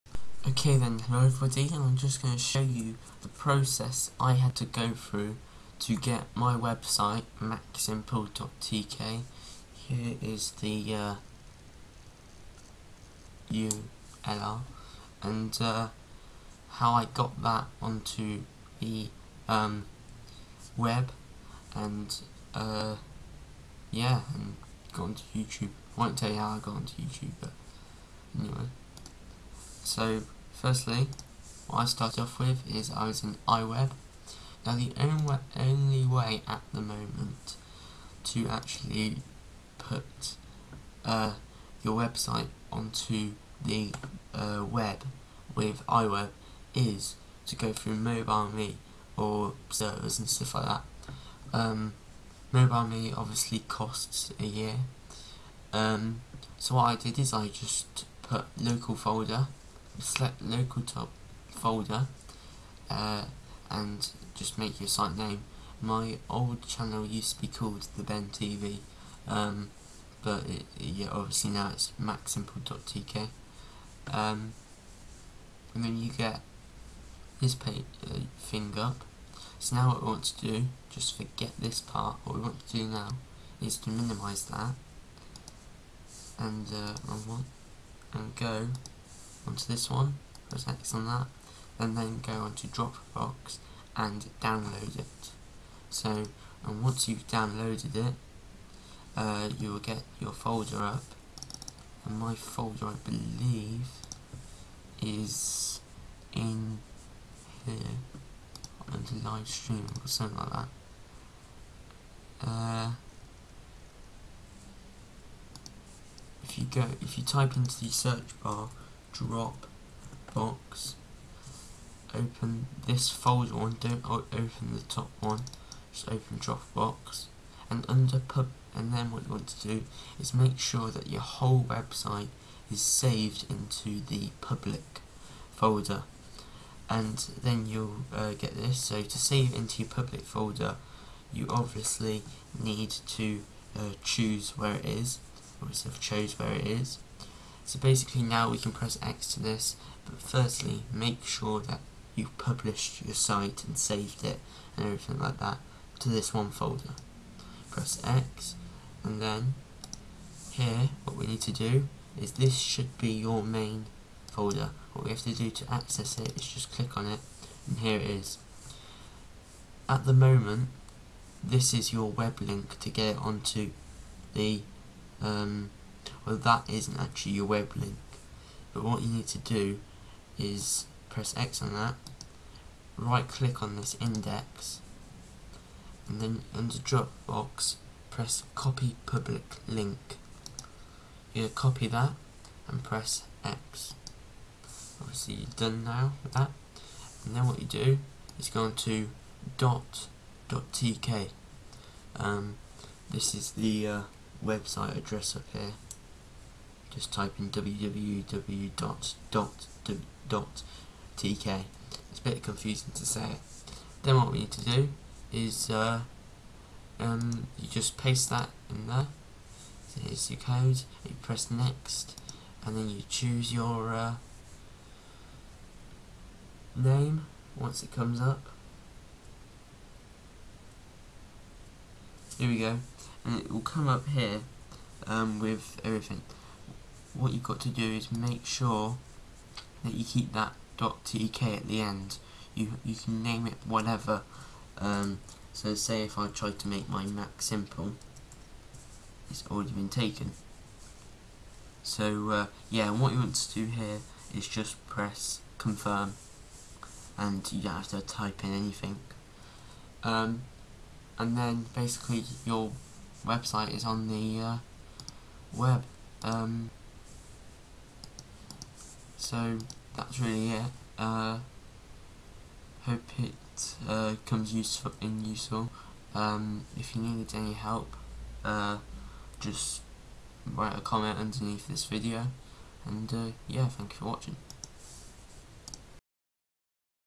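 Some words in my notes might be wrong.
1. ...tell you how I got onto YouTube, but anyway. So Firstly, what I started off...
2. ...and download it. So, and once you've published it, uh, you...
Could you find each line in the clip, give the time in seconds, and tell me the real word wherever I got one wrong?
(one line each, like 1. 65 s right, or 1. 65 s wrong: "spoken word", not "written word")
1. 26 s right
2. 93 s wrong: "downloaded", not "published".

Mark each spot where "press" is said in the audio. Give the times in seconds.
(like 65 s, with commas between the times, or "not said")
90 s, 148 s, 157 s, 181 s, 188 s, 192 s, 221 s, 254 s.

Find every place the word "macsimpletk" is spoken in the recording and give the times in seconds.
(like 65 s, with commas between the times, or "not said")
7 s, 71 s.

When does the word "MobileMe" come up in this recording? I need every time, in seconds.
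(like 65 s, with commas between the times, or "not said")
47 s, 52 s.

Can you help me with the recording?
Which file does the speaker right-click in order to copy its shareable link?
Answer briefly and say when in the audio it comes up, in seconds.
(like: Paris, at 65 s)
index, at 184 s.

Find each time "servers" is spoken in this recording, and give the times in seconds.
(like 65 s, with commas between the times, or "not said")
49 s.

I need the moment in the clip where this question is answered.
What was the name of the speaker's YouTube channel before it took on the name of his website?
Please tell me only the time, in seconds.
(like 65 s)
67 s.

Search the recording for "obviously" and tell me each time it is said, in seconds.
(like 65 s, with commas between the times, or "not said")
53 s, 71 s, 141 s, 145 s, 195 s.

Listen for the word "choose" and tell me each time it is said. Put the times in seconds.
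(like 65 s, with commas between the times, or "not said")
144 s, 223 s.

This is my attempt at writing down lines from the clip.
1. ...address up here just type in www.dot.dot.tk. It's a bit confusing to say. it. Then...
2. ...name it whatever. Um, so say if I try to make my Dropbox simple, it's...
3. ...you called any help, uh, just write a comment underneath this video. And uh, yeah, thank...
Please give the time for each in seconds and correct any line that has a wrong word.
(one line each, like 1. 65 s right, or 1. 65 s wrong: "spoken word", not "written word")
1. 204 s right
2. 243 s wrong: "Mac", not "Dropbox"
3. 276 s wrong: "needed", not "called".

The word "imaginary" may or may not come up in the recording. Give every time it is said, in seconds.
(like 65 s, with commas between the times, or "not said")
not said.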